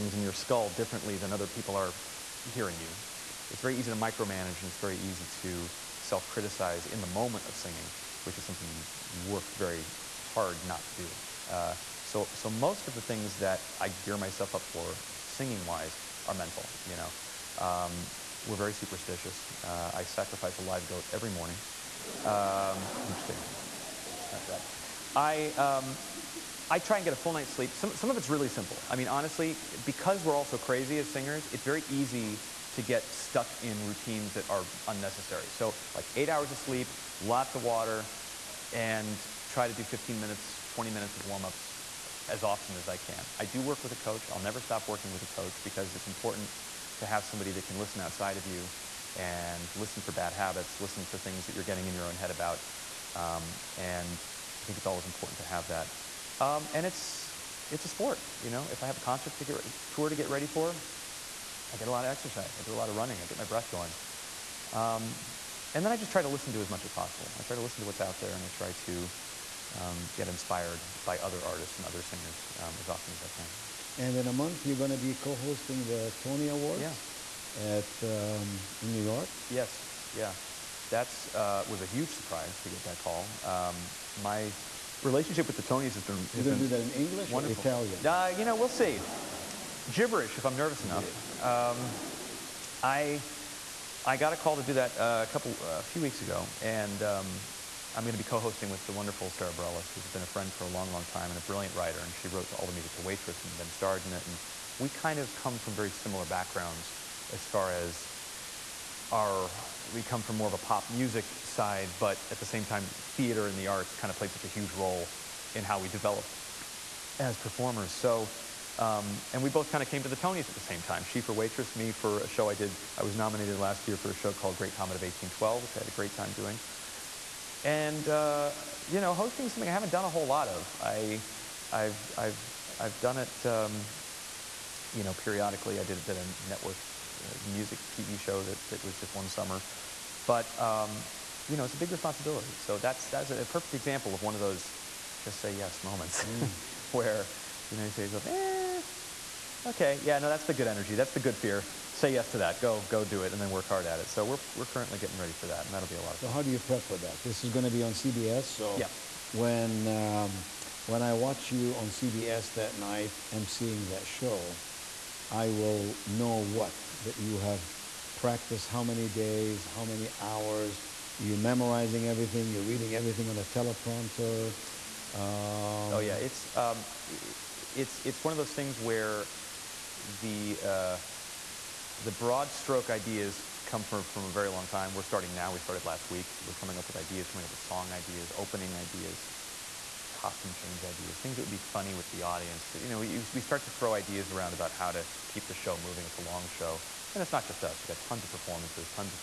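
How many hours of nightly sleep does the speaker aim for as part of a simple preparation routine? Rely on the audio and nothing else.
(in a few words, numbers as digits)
8.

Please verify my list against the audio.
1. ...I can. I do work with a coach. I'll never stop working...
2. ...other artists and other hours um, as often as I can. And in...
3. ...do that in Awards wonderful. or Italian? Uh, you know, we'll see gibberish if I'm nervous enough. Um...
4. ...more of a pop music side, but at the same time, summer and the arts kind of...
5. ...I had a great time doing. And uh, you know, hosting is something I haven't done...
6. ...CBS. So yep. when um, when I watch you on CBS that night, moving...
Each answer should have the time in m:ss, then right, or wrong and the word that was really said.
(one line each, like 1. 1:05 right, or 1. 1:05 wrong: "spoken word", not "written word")
1. 0:42 right
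2. 1:11 wrong: "singers", not "hours"
3. 1:26 wrong: "English", not "Awards"
4. 1:50 wrong: "theater", not "summer"
5. 2:05 right
6. 2:37 wrong: "emceeing", not "moving".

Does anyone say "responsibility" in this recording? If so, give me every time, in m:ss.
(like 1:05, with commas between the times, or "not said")
2:21.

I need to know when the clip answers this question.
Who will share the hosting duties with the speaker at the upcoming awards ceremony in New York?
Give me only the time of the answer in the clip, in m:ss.
1:39.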